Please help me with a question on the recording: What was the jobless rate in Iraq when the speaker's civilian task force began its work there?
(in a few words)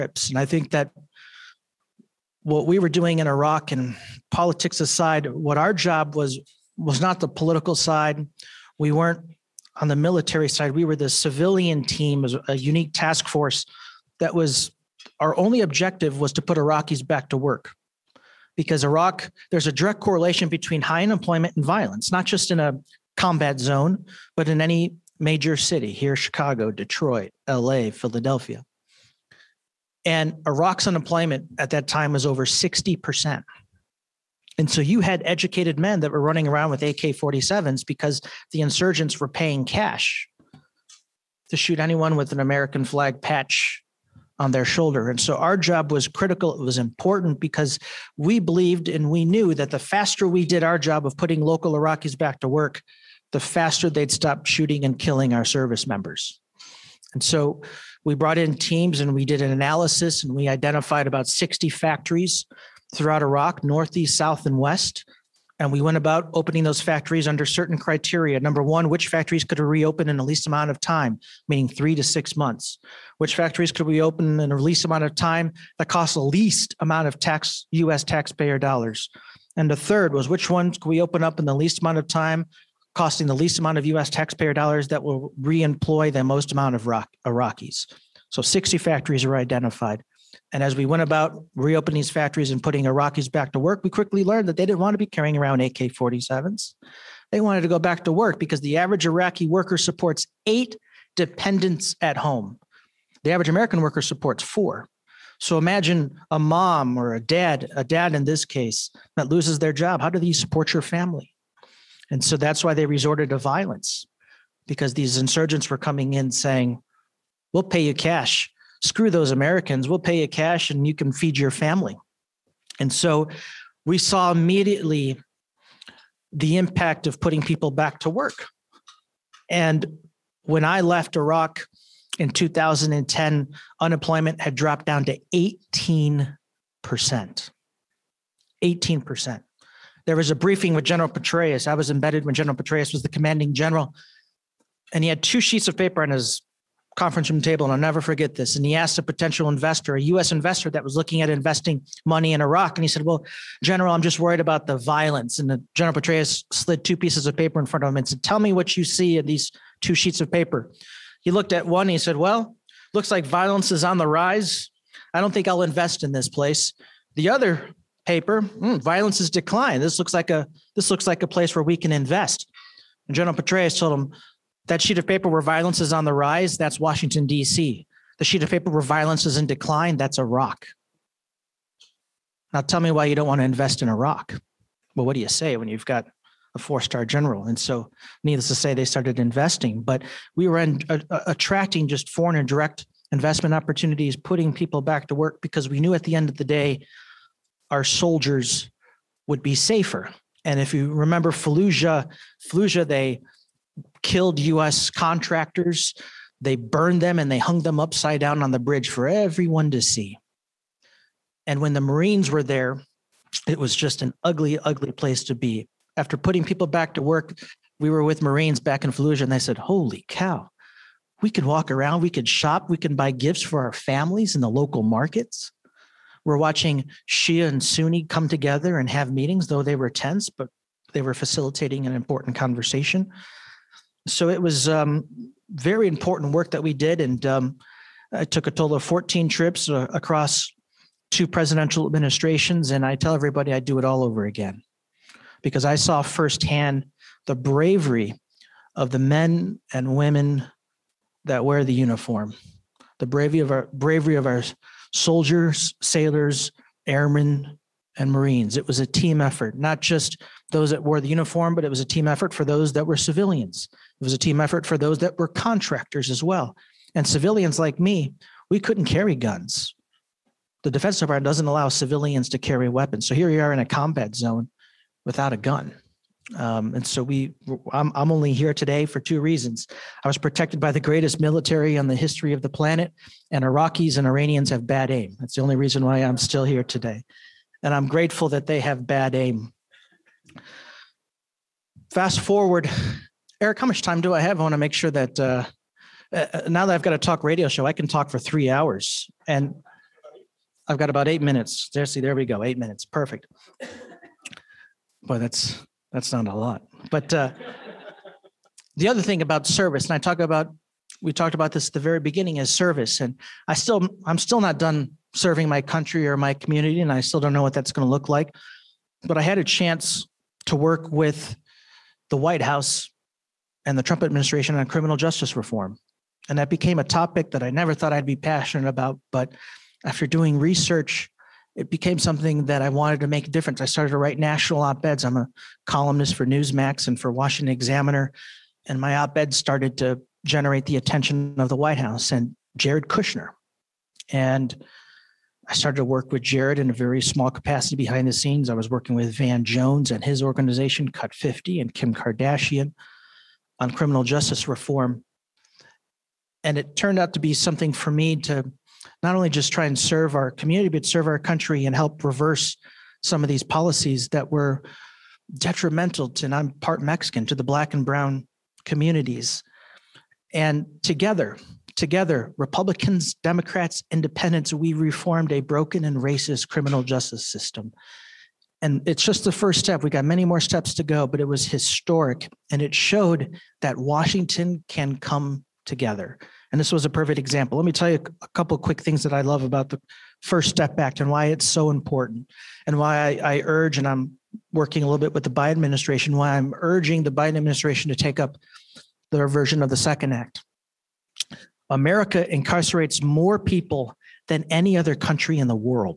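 over 60%.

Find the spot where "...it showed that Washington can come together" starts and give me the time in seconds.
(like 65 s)
382 s.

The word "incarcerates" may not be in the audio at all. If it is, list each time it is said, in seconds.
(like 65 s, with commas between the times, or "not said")
402 s.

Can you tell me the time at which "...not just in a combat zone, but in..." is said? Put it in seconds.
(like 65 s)
22 s.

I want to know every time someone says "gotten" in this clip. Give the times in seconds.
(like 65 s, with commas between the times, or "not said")
not said.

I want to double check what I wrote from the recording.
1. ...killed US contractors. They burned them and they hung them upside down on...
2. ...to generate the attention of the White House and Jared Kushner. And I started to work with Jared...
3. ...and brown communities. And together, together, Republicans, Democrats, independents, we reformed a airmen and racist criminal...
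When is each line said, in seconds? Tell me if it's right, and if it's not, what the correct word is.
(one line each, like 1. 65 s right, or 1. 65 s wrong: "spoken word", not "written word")
1. 204 s right
2. 339 s right
3. 367 s wrong: "broken", not "airmen".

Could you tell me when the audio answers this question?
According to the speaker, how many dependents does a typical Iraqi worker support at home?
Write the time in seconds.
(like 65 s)
100 s.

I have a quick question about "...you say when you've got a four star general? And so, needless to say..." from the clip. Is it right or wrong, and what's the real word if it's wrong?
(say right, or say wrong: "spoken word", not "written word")
right.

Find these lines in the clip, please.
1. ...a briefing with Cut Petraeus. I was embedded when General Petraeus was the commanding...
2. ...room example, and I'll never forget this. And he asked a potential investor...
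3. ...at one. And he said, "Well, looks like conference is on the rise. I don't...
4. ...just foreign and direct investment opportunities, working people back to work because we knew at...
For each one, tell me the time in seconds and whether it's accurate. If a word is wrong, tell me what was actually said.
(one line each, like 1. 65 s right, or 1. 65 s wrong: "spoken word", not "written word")
1. 140 s wrong: "General", not "Cut"
2. 147 s wrong: "table", not "example"
3. 161 s wrong: "violence", not "conference"
4. 191 s wrong: "putting", not "working".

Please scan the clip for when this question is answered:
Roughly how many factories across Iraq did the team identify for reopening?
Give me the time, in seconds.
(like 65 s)
61 s.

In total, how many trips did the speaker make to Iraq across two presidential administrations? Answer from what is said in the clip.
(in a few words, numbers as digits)
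14.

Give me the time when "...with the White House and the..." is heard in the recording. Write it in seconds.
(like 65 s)
320 s.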